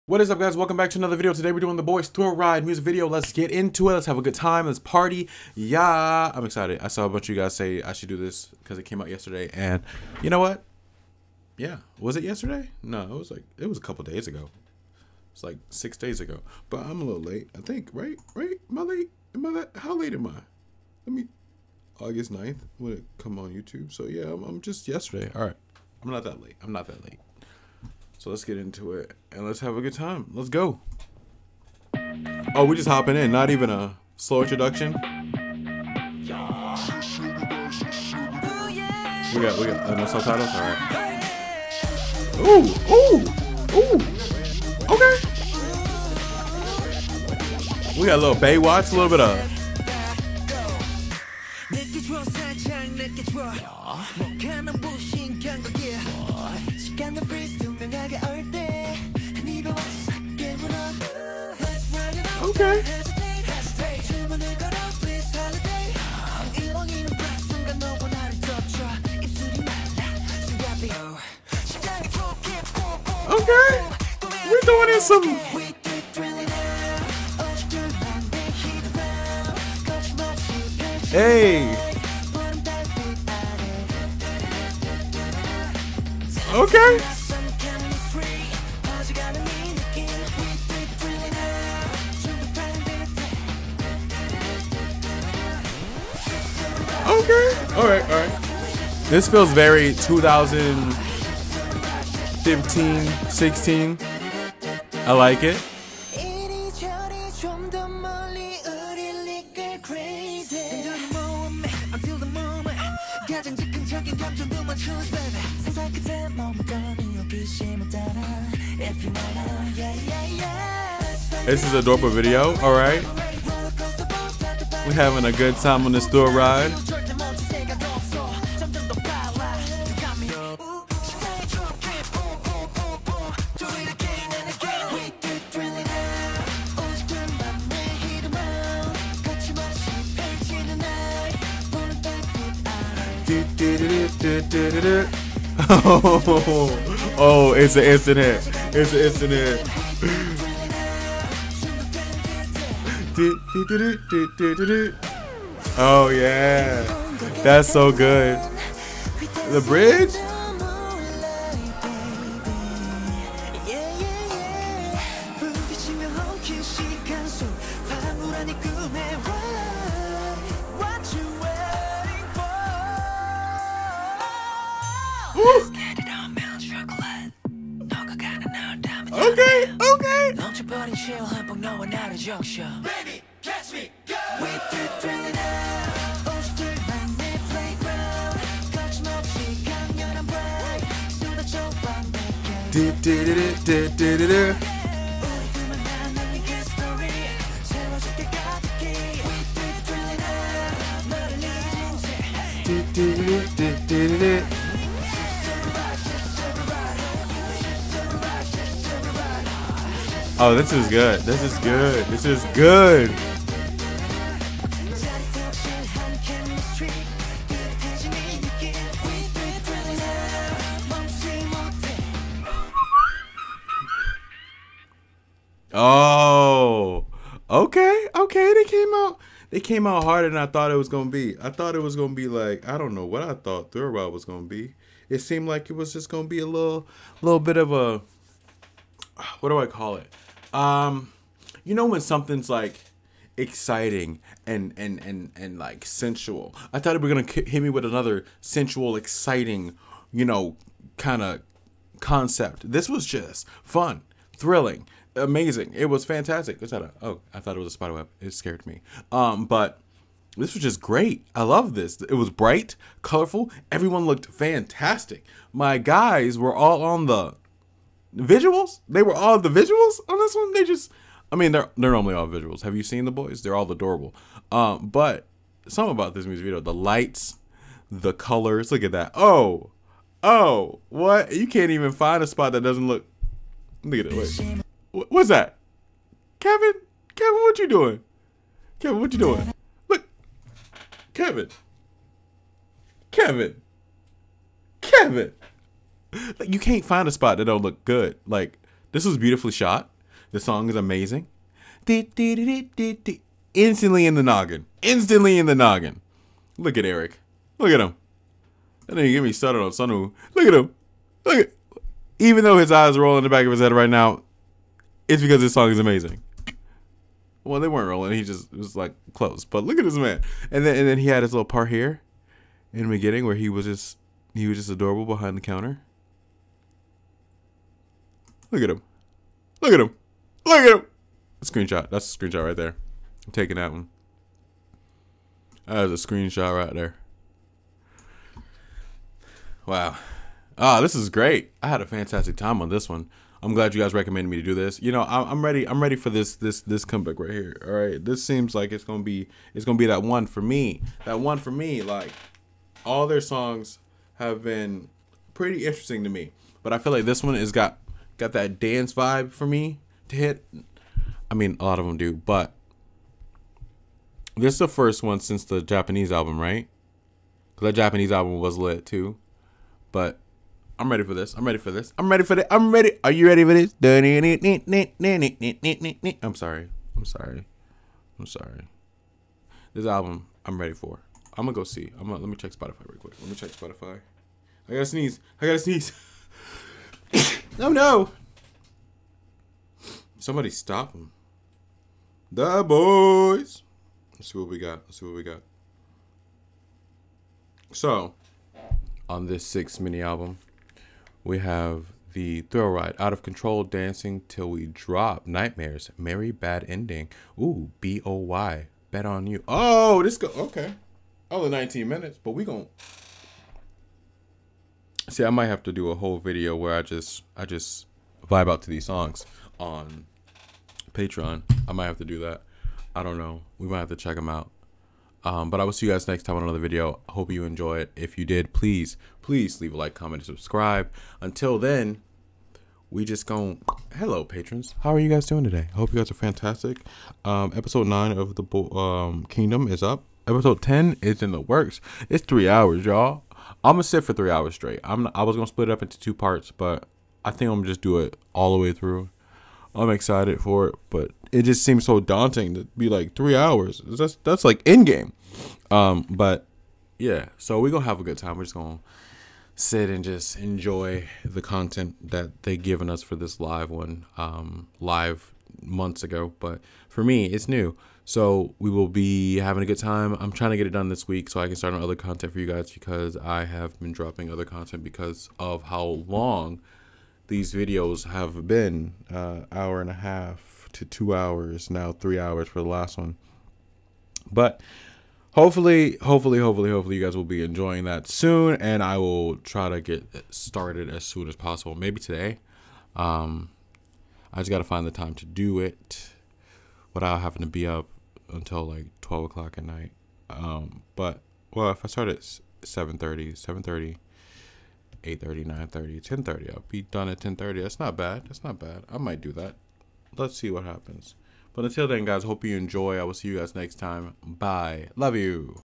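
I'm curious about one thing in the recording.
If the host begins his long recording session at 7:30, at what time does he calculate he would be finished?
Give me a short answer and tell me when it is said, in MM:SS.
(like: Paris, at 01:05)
10:30, at 08:27.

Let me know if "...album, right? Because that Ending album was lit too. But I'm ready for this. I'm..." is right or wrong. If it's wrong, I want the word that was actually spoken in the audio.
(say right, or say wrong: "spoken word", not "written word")
wrong: "Japanese", not "Ending".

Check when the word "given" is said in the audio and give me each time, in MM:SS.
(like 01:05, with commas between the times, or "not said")
07:42.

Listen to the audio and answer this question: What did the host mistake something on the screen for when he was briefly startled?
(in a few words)
Spider web.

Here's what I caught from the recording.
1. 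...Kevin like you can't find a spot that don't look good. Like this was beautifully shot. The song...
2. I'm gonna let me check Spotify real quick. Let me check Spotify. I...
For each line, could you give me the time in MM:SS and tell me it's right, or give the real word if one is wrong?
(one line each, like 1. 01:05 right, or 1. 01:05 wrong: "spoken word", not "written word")
1. 04:54 right
2. 06:21 right.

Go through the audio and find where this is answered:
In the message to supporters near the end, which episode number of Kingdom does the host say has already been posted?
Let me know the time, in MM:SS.
07:17.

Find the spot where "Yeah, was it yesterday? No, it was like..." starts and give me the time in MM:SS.
00:11.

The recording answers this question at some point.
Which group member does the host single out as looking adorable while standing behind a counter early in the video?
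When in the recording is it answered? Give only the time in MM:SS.
05:09.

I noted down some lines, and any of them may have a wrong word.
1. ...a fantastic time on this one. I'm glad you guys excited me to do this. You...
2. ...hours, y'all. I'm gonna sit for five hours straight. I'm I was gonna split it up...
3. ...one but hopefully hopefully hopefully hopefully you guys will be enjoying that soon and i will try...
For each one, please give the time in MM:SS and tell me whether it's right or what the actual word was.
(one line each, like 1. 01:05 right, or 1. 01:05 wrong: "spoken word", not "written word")
1. 05:41 wrong: "recommended", not "excited"
2. 07:22 wrong: "three", not "five"
3. 08:02 right.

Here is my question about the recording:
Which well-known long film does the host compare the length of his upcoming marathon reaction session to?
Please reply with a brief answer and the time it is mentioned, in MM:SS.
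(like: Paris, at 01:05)
Endgame, at 07:34.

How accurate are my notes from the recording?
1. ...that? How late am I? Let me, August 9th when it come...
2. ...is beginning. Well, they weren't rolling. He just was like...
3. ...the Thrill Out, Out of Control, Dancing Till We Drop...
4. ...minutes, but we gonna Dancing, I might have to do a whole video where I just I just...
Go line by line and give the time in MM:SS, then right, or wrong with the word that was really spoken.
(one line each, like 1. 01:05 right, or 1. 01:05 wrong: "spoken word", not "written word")
1. 00:19 right
2. 05:15 wrong: "amazing", not "beginning"
3. 06:42 wrong: "Ride", not "Out"
4. 06:51 wrong: "See", not "Dancing".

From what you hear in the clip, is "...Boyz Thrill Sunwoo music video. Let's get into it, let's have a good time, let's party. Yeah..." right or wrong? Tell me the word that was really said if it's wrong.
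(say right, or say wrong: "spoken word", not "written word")
wrong: "Ride", not "Sunwoo".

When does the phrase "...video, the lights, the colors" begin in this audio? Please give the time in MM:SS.
04:36.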